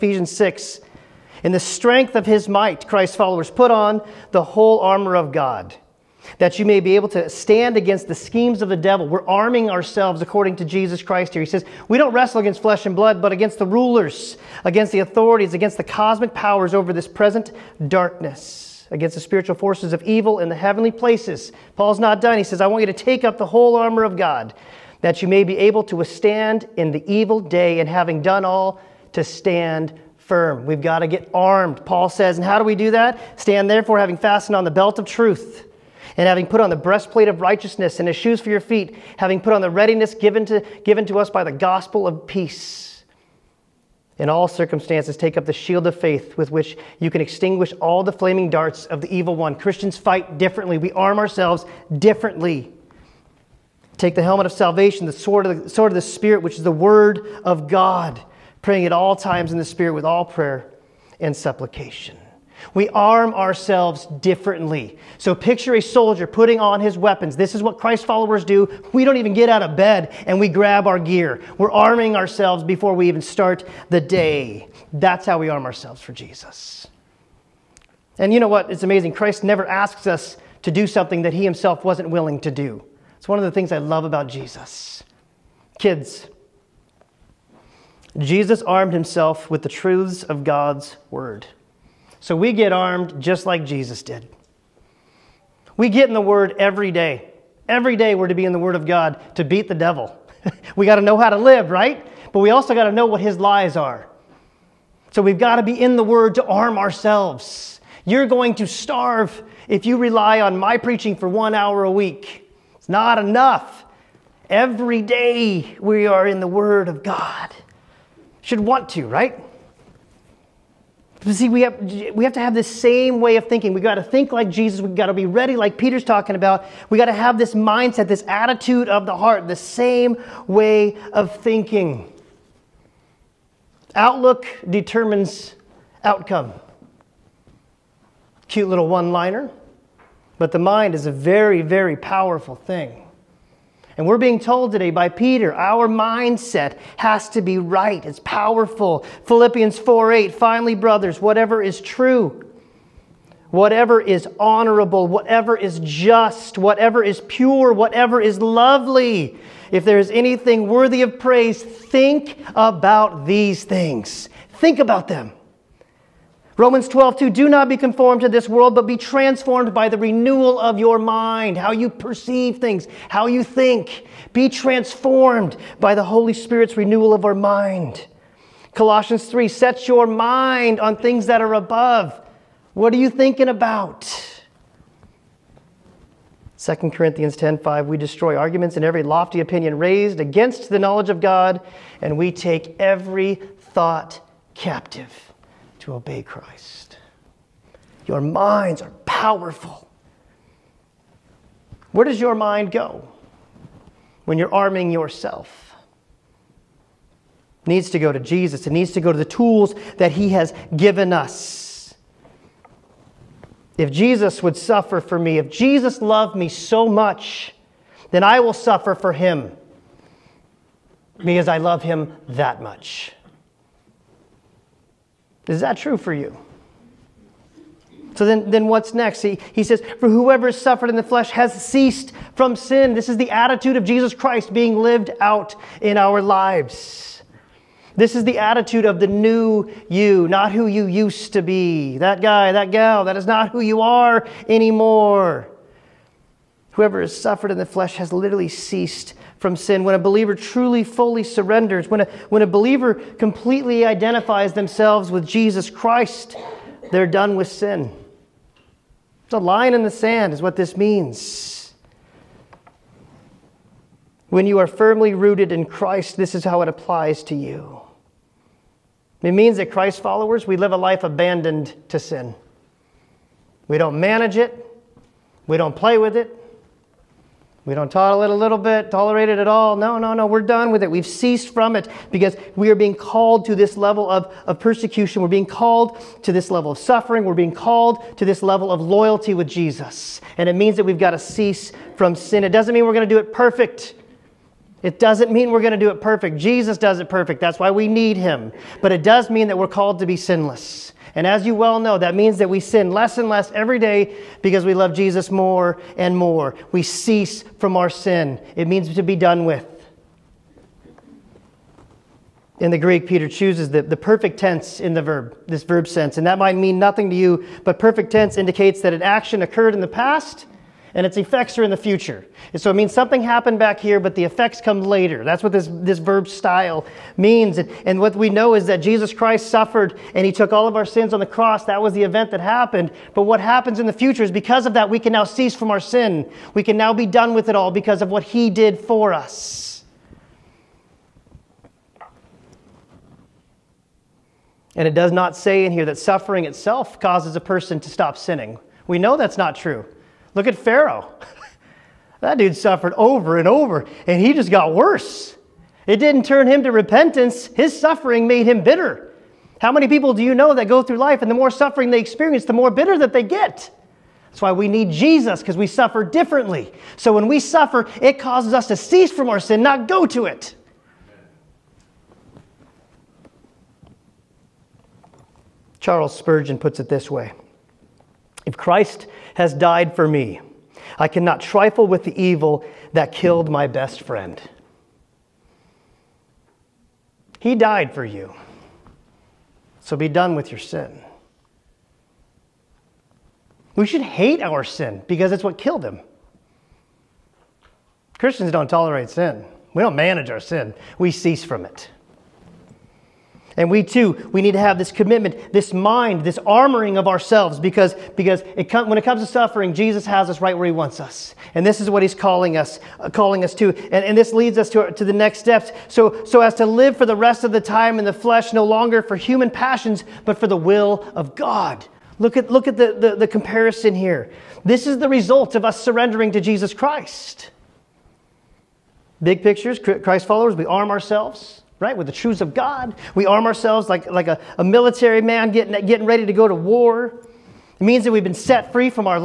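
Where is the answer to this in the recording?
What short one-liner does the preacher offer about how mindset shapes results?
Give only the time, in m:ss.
2:13.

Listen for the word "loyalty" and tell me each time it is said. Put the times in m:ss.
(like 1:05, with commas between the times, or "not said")
4:48.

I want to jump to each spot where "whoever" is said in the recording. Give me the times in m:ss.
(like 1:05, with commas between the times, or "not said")
3:50, 4:06.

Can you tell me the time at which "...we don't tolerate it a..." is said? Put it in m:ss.
4:37.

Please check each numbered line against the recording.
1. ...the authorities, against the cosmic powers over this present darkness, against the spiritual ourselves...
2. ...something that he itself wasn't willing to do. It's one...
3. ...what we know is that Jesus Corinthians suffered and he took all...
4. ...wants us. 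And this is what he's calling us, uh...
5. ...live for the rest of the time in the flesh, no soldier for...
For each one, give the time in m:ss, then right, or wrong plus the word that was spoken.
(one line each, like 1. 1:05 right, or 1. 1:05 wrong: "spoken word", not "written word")
1. 0:14 wrong: "forces", not "ourselves"
2. 1:20 wrong: "himself", not "itself"
3. 5:27 wrong: "Christ", not "Corinthians"
4. 6:50 right
5. 6:56 wrong: "longer", not "soldier".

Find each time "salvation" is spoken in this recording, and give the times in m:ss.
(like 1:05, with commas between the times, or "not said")
0:54.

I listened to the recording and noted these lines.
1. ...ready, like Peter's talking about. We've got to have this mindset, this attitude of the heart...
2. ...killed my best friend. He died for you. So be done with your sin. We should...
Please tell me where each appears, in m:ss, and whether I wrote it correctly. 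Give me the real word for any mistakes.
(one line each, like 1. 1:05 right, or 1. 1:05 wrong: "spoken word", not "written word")
1. 2:05 right
2. 6:23 right.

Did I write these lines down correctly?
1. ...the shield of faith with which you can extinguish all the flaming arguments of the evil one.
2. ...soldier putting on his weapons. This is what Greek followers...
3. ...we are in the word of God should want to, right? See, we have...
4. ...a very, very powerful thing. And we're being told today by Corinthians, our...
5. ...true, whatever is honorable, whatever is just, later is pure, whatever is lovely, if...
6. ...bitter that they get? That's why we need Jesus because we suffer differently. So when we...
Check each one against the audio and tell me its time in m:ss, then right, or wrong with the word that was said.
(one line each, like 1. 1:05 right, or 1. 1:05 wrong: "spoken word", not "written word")
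1. 0:45 wrong: "darts", not "arguments"
2. 1:05 wrong: "Christ", not "Greek"
3. 1:55 right
4. 2:21 wrong: "Peter", not "Corinthians"
5. 2:31 wrong: "whatever", not "later"
6. 6:02 right.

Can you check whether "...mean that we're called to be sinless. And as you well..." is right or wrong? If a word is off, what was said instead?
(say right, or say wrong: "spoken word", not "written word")
right.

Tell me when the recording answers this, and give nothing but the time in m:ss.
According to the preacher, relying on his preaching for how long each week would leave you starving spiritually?
1:51.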